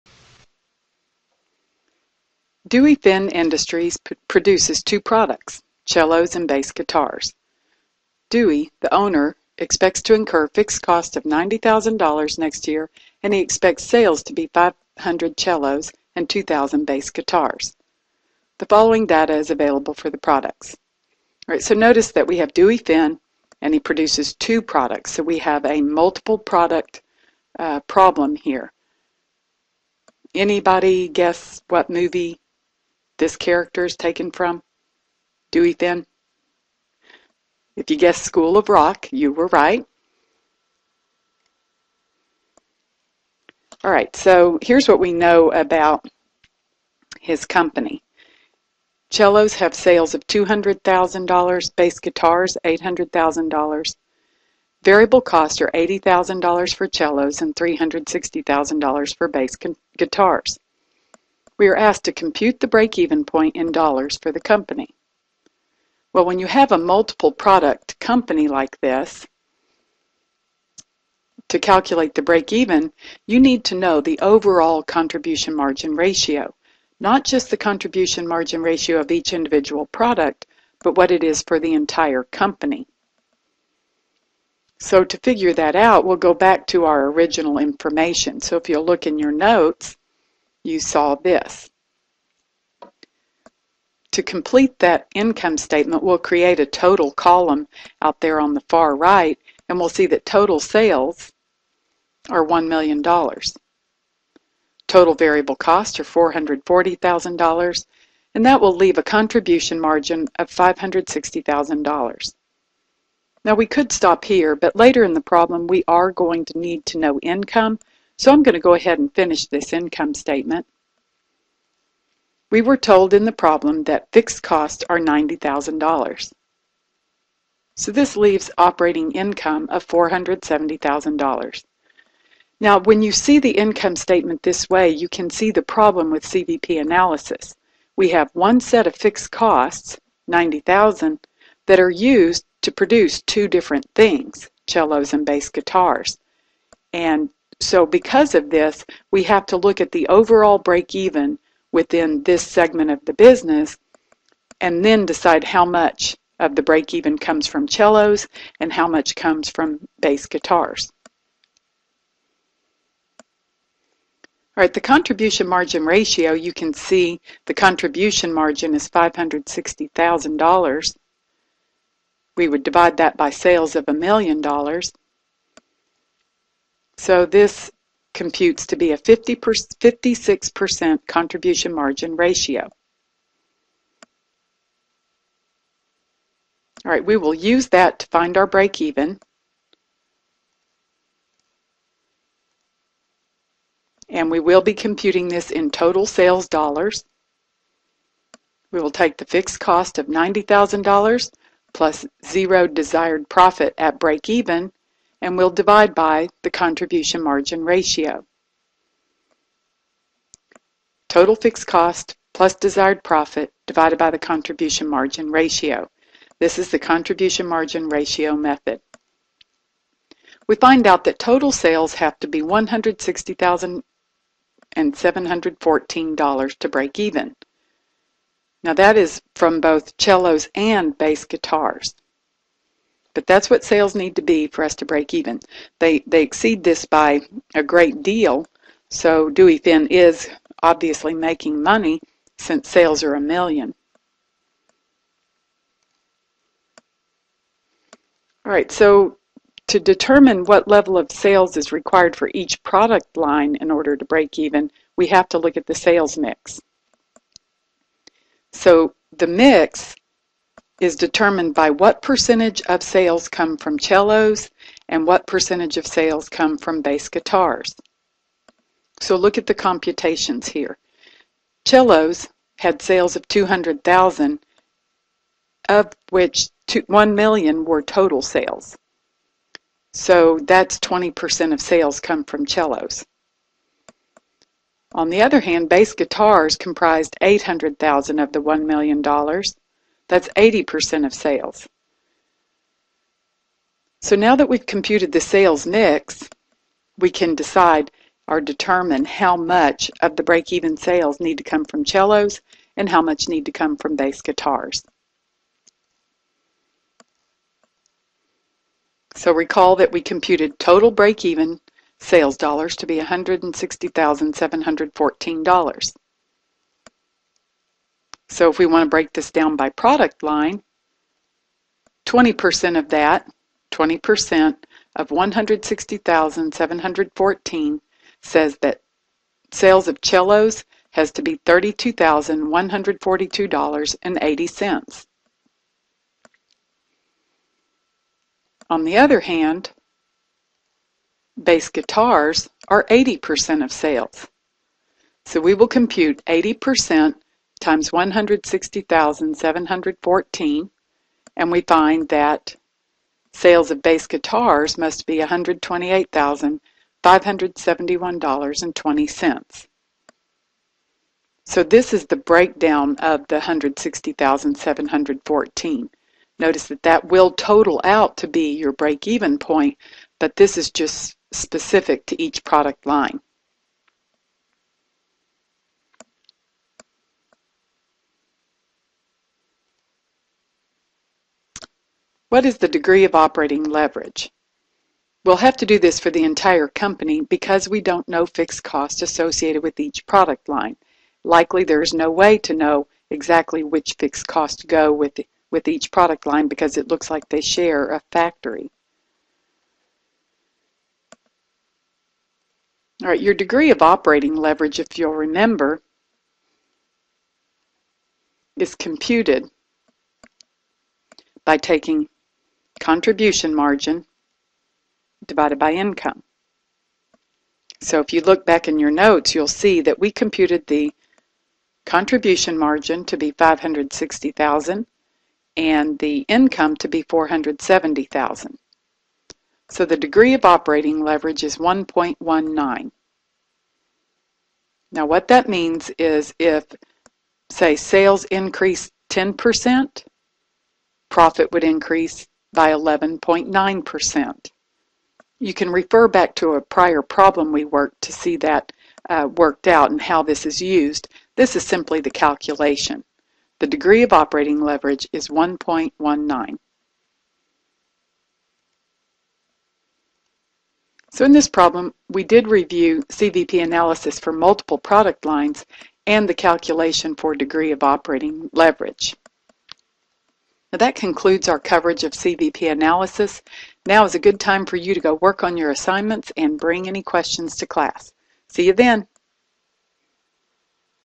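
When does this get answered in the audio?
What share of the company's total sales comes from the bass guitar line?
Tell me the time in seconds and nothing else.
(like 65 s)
290 s.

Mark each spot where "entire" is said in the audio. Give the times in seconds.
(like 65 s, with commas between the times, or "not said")
81 s, 386 s.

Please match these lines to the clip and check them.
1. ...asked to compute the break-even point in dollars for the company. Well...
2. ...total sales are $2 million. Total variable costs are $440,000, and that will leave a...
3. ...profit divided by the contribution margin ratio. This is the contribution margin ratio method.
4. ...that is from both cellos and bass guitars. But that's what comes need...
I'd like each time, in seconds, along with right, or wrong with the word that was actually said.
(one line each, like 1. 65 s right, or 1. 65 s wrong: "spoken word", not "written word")
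1. 61 s right
2. 100 s wrong: "1", not "2"
3. 213 s right
4. 228 s wrong: "sales", not "comes".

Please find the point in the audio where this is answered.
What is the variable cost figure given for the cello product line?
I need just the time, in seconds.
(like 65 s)
55 s.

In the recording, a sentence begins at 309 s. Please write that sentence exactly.
So recall that we computed total break-even sales dollars to be $160,714.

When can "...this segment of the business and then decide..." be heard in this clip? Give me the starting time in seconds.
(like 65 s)
152 s.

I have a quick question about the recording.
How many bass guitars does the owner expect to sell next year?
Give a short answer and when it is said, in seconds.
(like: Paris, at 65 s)
2,000, at 16 s.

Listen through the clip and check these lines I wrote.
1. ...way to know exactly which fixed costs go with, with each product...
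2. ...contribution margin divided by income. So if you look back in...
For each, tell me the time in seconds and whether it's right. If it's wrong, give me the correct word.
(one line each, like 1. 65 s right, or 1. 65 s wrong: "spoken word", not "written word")
1. 392 s right
2. 412 s right.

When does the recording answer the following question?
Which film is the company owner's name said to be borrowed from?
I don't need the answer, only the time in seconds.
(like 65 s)
38 s.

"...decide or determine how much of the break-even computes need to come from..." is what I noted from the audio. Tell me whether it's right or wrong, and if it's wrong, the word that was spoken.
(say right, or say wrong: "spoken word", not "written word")
wrong: "sales", not "computes".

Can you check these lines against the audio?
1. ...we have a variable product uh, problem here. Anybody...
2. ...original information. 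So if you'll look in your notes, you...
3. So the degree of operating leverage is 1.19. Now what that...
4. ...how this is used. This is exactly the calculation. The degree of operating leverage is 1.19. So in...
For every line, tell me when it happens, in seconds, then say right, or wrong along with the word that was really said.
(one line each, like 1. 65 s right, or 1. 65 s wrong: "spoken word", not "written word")
1. 25 s wrong: "multiple", not "variable"
2. 87 s right
3. 429 s right
4. 450 s wrong: "simply", not "exactly".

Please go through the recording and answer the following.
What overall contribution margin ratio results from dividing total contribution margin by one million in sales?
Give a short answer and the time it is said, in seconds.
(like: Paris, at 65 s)
56%, at 178 s.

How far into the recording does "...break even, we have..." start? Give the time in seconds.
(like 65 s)
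254 s.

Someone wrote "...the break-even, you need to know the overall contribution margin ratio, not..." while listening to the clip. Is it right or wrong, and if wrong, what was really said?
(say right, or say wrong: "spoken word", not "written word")
right.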